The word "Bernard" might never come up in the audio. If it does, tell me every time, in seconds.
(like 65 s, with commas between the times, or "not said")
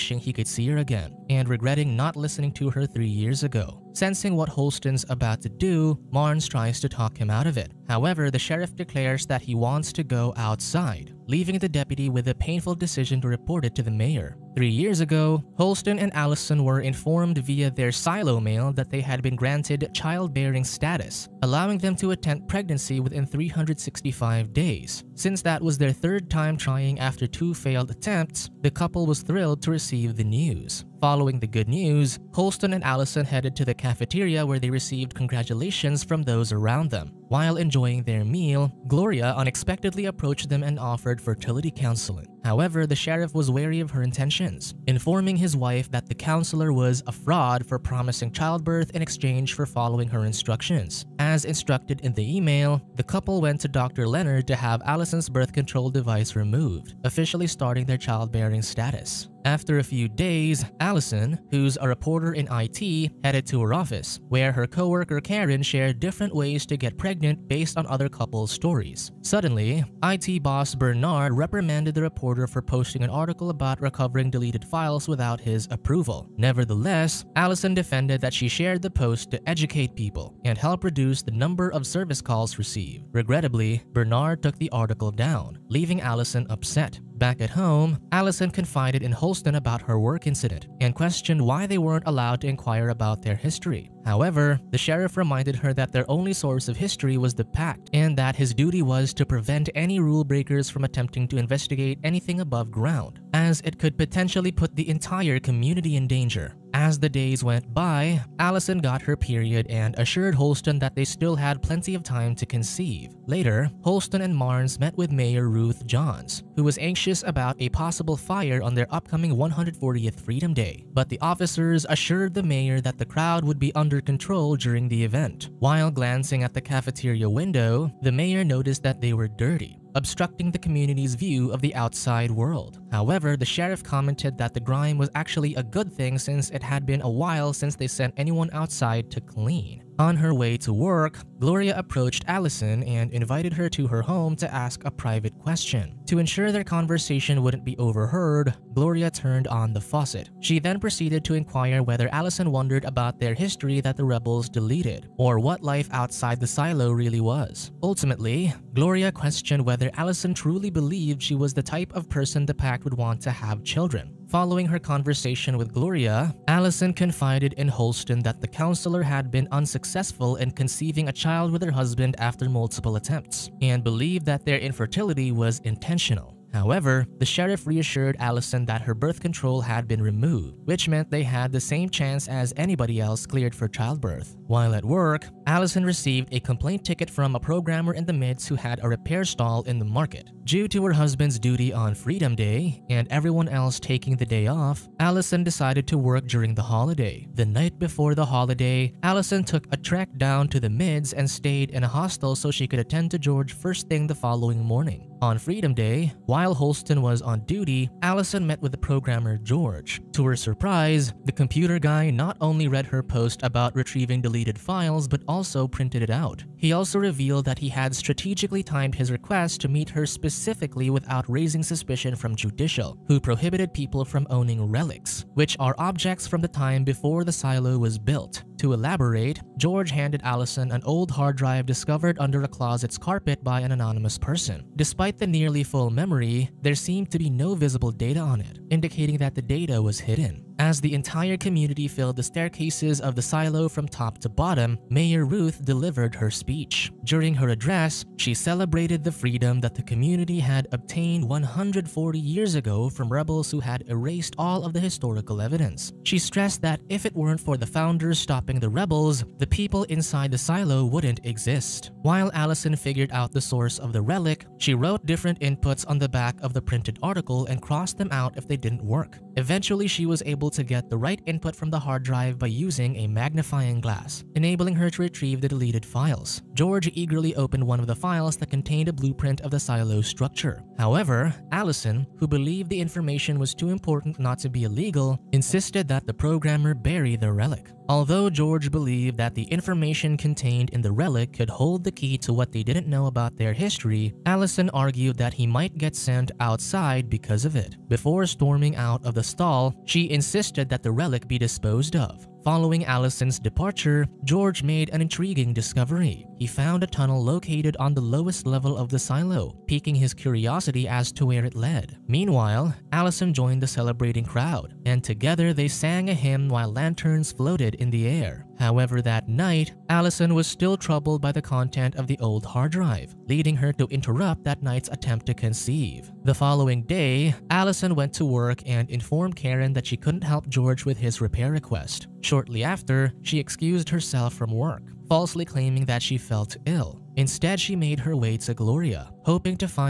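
70 s, 83 s.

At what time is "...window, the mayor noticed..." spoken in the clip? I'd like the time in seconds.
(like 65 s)
127 s.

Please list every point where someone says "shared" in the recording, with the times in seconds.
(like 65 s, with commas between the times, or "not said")
65 s, 78 s.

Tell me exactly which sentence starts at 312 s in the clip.
Meanwhile, Allison joined the celebrating crowd, and together they sang a hymn while lanterns floated in the air.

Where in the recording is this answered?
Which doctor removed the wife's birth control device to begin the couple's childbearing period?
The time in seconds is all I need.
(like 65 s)
53 s.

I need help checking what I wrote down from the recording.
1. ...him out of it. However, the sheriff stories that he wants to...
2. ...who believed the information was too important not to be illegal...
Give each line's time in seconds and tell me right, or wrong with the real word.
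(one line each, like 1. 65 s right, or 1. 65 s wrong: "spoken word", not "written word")
1. 7 s wrong: "declares", not "stories"
2. 282 s right.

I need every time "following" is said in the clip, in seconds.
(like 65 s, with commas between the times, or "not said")
30 s, 49 s, 164 s, 204 s, 302 s, 326 s.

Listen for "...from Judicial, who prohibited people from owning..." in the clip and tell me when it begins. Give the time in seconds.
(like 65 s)
222 s.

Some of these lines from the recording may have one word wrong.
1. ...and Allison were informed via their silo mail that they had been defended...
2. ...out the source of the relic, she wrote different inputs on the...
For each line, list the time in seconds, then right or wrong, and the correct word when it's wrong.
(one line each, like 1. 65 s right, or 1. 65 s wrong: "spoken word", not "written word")
1. 15 s wrong: "granted", not "defended"
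2. 263 s right.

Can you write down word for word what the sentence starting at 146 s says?
To ensure their conversation wouldn't be overheard, Gloria turned on the faucet.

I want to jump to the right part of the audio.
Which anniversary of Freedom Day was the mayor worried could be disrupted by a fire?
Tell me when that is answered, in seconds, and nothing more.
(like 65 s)
119 s.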